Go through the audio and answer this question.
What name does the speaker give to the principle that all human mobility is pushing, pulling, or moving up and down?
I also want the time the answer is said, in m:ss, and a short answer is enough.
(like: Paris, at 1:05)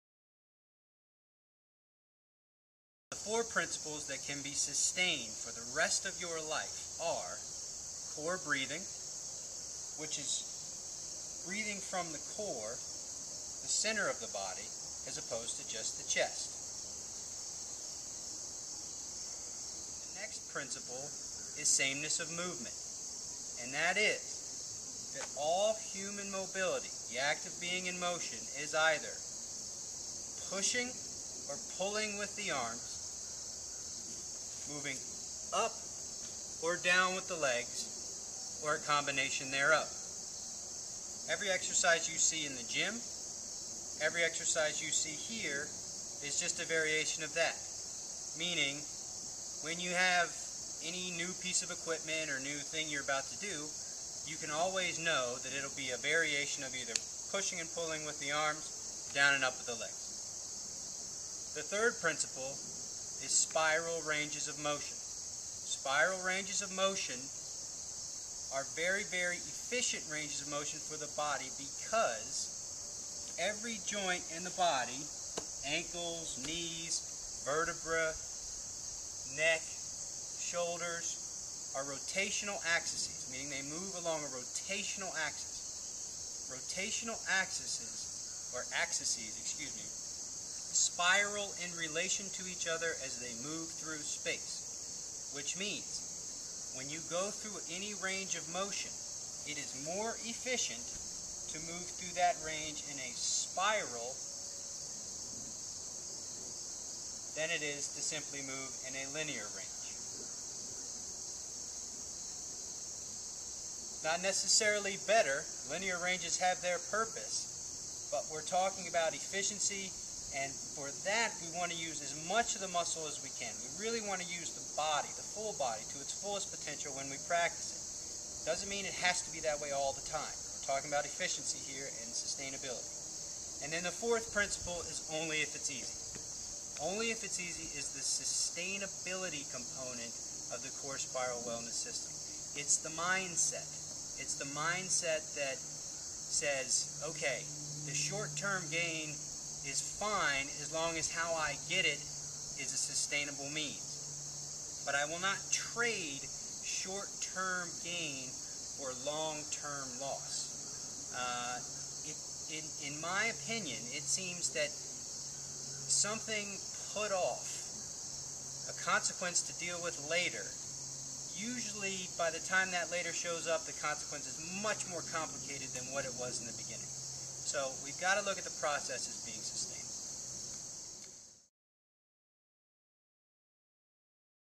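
Sameness of movement, at 0:21.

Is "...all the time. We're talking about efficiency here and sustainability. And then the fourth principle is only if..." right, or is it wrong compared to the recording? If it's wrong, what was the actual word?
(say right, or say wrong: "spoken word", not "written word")
right.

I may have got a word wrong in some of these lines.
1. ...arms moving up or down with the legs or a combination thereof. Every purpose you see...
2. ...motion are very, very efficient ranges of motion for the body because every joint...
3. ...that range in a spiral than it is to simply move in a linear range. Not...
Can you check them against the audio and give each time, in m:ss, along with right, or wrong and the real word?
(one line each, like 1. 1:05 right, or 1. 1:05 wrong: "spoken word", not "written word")
1. 0:32 wrong: "exercise", not "purpose"
2. 1:06 right
3. 1:42 right.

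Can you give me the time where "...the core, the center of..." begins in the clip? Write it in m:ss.
0:12.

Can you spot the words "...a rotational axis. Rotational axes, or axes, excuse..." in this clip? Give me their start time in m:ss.
1:24.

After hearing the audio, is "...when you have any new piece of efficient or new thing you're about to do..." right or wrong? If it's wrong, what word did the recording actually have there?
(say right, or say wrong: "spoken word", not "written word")
wrong: "equipment", not "efficient".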